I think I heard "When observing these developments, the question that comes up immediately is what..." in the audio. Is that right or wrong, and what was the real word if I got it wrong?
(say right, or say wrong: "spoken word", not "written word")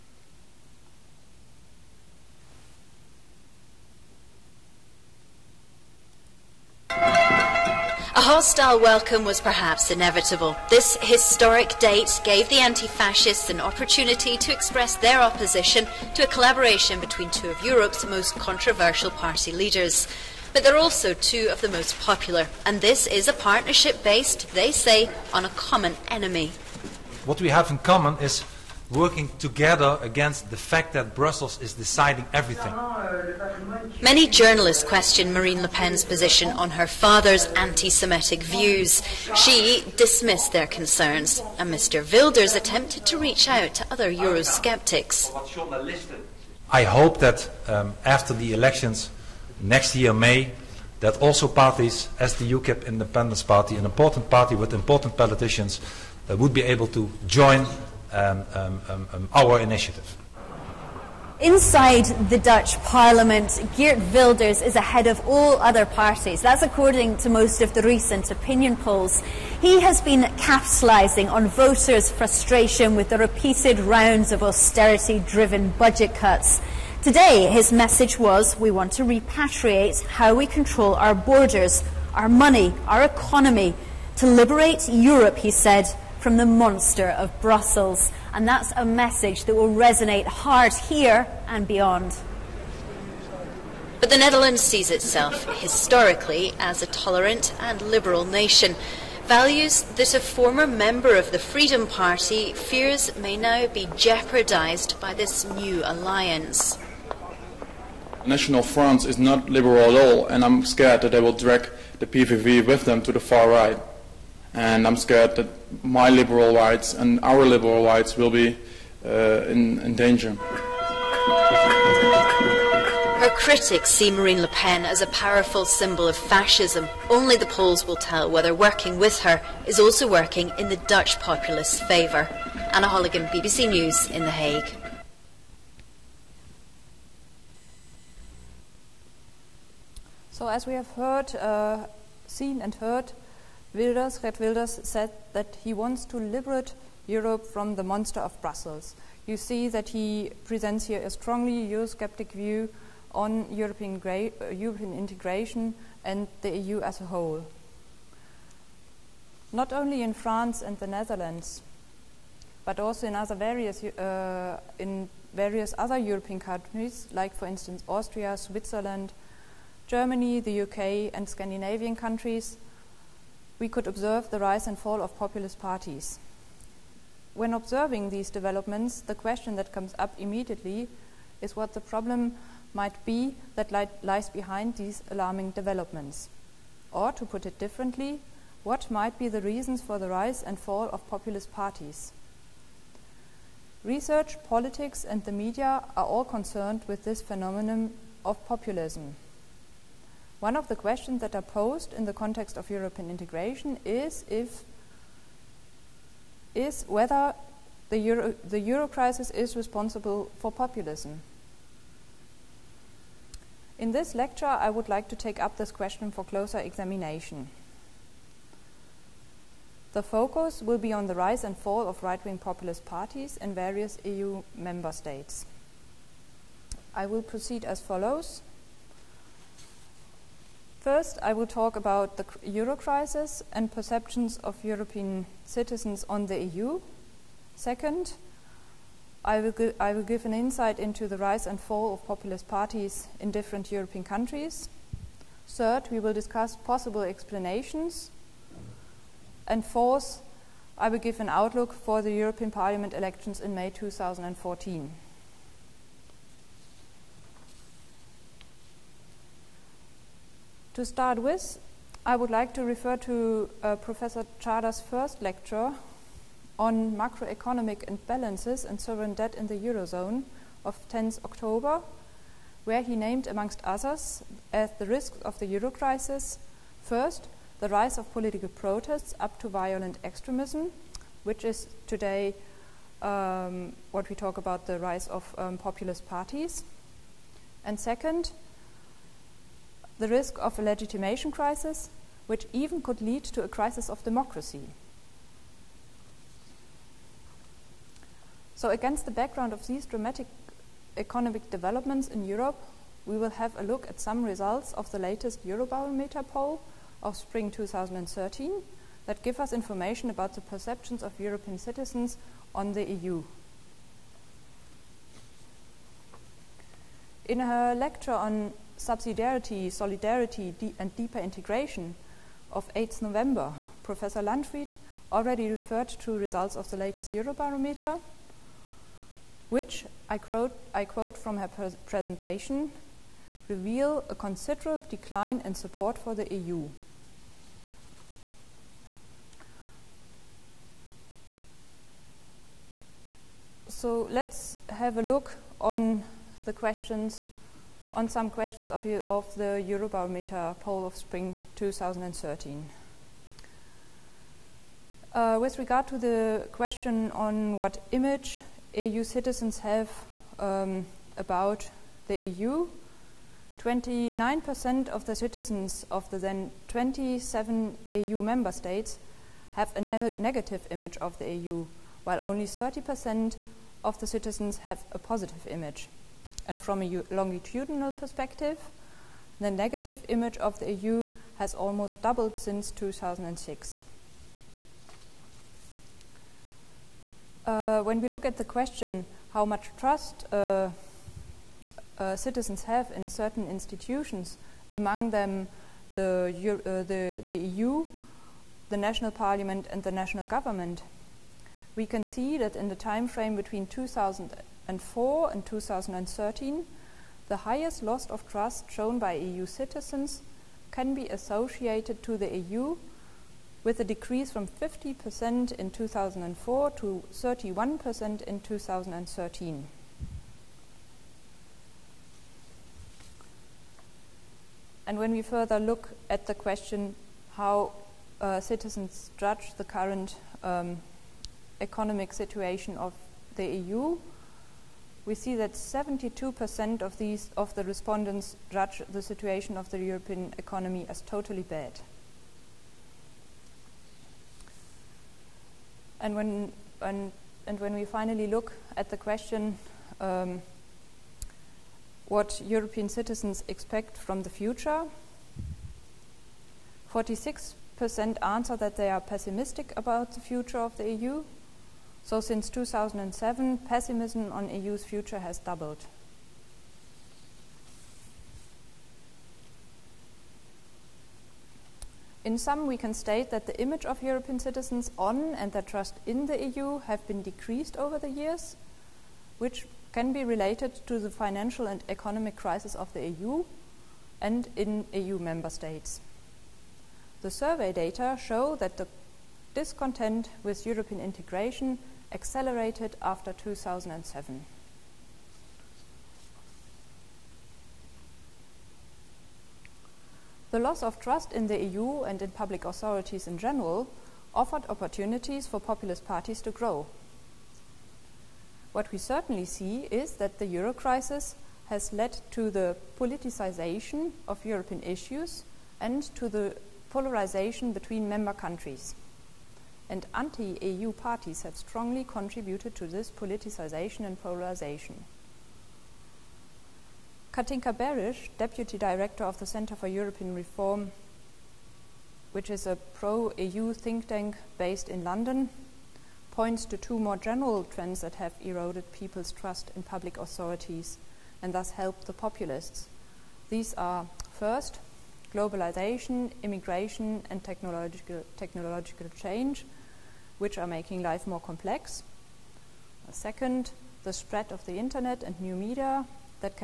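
right.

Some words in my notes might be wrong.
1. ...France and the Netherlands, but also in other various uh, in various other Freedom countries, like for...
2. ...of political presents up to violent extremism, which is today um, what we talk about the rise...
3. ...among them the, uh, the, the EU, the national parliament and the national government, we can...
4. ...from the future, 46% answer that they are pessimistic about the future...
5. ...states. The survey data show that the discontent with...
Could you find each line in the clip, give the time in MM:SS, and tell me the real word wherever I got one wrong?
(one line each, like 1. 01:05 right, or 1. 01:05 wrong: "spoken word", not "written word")
1. 02:40 wrong: "European", not "Freedom"
2. 04:37 wrong: "protests", not "presents"
3. 06:34 right
4. 07:33 right
5. 08:05 right.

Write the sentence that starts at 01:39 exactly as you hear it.
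Values that a former member of the Freedom Party fears may now be jeopardized by this new alliance.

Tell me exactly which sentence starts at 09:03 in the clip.
These are, first, globalization, immigration and technological, technological change – which are making life more complex.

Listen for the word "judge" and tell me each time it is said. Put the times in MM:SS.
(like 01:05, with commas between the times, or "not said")
07:09, 07:18.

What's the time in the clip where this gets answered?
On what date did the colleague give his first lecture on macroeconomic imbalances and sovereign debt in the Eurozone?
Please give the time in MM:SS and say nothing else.
04:30.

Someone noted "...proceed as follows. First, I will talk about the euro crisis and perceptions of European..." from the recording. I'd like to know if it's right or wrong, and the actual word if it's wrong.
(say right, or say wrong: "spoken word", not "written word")
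right.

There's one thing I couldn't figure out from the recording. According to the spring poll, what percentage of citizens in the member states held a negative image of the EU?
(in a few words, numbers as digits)
29%.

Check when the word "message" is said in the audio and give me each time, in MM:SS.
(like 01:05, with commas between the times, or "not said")
01:17, 01:28.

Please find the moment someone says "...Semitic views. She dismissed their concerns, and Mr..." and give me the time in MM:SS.
00:37.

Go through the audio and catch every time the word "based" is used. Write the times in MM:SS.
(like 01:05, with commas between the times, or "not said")
00:24, 08:54.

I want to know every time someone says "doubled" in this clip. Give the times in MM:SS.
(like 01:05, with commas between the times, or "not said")
06:22, 07:45.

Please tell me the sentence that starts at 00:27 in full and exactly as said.
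What we have in common is working together against the fact that Brussels is deciding everything.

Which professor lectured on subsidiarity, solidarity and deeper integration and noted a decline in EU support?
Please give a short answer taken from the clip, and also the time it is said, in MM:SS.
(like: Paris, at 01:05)
Professor Landfried, at 05:23.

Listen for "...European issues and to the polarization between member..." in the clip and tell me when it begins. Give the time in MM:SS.
08:34.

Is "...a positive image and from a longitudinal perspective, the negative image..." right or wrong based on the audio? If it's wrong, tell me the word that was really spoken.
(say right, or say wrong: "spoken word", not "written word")
right.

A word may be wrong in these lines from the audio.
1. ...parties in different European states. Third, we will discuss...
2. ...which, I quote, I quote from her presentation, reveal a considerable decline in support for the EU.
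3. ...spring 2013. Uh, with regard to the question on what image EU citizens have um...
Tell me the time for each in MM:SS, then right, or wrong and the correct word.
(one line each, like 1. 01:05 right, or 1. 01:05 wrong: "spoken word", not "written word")
1. 04:02 wrong: "countries", not "states"
2. 05:29 right
3. 05:50 right.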